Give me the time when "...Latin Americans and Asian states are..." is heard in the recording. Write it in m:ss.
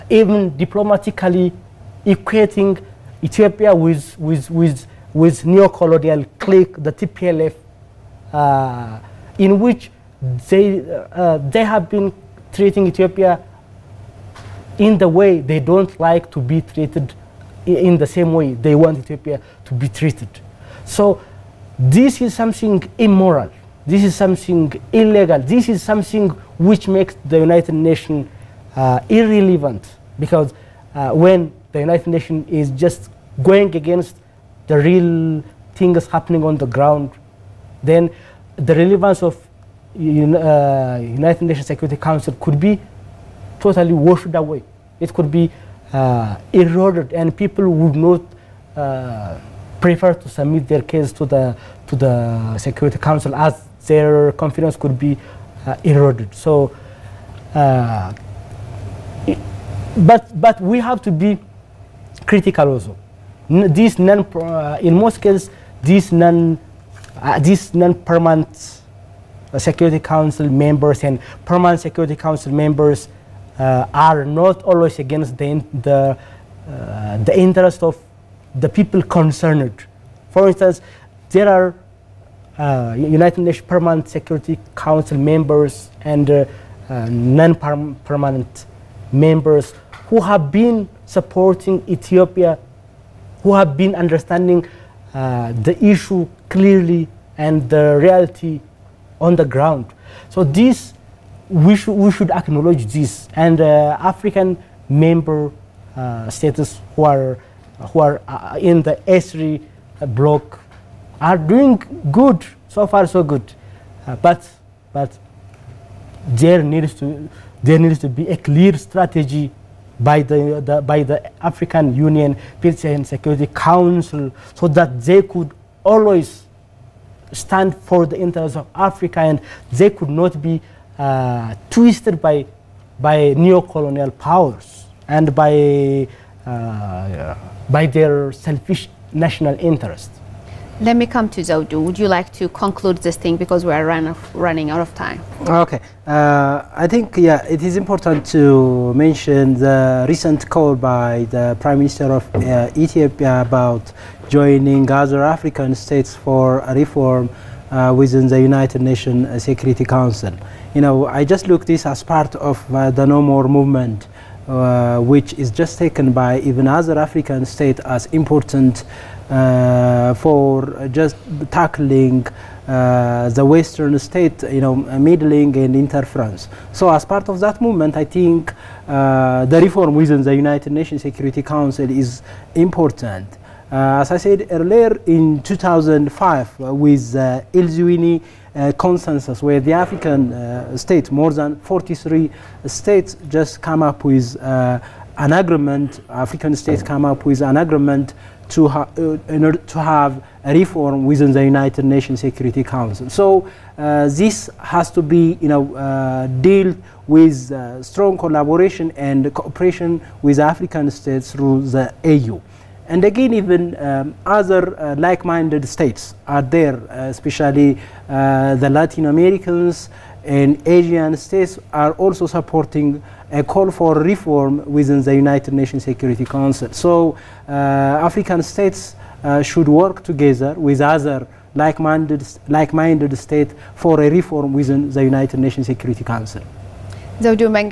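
3:38.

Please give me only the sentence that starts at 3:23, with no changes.
So uh, this has to be you know, uh, dealt with strong collaboration and cooperation with African states through the AU.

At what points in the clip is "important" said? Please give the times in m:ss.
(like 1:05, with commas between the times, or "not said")
2:27, 2:48, 3:02.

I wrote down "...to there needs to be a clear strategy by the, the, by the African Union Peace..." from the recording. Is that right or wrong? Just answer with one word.
right.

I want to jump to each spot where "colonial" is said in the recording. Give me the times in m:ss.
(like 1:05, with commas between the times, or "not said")
0:05, 2:13.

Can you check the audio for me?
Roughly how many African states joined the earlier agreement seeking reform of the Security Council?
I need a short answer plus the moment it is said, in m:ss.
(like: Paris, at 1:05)
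more than 43, at 3:11.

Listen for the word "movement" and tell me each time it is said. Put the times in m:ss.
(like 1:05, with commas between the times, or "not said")
2:43, 2:57.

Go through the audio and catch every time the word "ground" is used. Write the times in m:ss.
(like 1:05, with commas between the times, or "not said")
0:36, 1:39.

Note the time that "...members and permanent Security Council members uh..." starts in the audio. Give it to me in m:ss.
1:10.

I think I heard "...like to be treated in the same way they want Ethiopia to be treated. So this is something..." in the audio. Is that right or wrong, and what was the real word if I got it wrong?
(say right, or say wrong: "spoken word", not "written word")
right.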